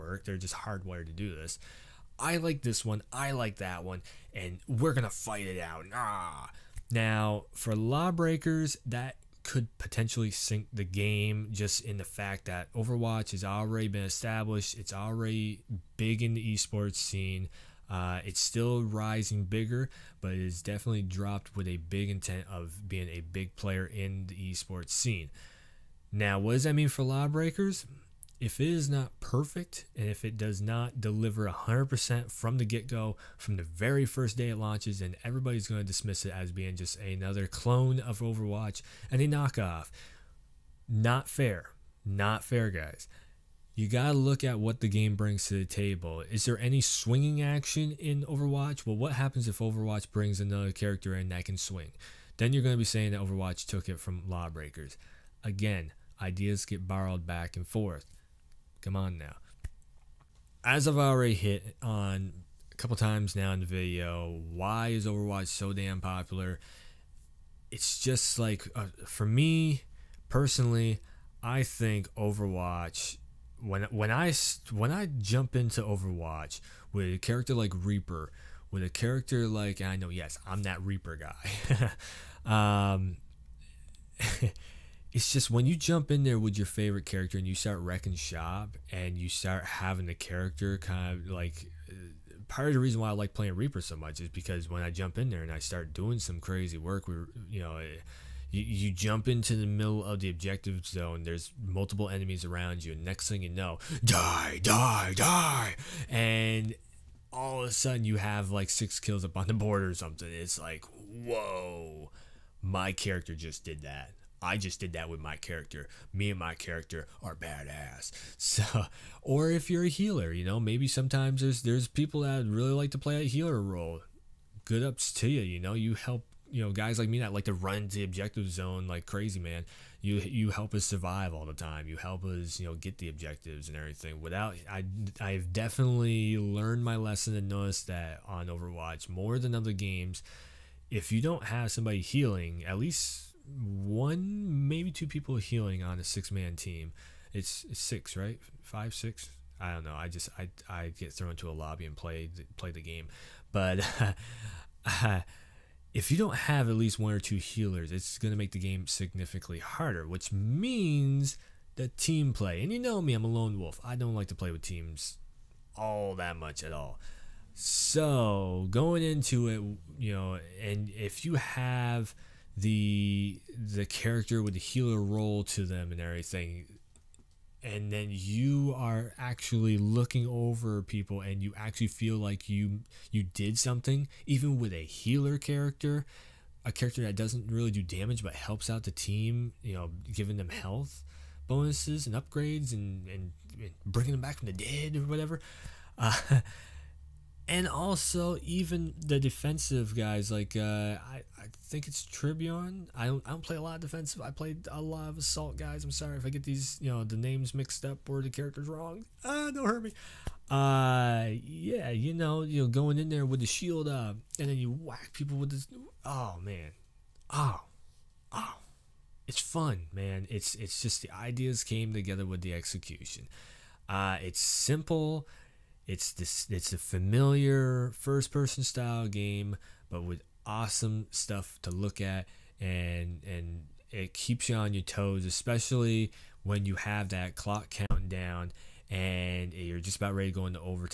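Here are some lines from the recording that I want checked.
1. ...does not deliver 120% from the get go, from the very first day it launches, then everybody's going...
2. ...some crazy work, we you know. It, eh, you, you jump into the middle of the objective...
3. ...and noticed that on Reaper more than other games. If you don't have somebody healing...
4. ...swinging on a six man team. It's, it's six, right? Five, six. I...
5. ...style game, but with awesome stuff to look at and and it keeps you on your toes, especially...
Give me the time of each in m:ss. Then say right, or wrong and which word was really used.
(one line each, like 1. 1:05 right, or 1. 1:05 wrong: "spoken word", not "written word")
1. 0:30 wrong: "100", not "120"
2. 1:36 right
3. 2:17 wrong: "Overwatch", not "Reaper"
4. 2:25 wrong: "healing", not "swinging"
5. 3:48 right.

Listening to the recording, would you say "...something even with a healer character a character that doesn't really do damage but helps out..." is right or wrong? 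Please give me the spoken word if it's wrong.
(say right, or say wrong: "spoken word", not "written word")
right.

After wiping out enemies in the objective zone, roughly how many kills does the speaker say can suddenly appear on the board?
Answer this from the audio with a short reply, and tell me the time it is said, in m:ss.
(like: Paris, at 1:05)
6, at 1:48.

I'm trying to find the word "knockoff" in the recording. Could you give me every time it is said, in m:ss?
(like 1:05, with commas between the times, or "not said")
0:39.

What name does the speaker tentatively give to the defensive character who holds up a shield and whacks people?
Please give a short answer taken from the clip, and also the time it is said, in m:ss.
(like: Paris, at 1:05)
Tribune, at 3:22.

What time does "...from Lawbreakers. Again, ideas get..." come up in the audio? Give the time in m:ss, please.
0:53.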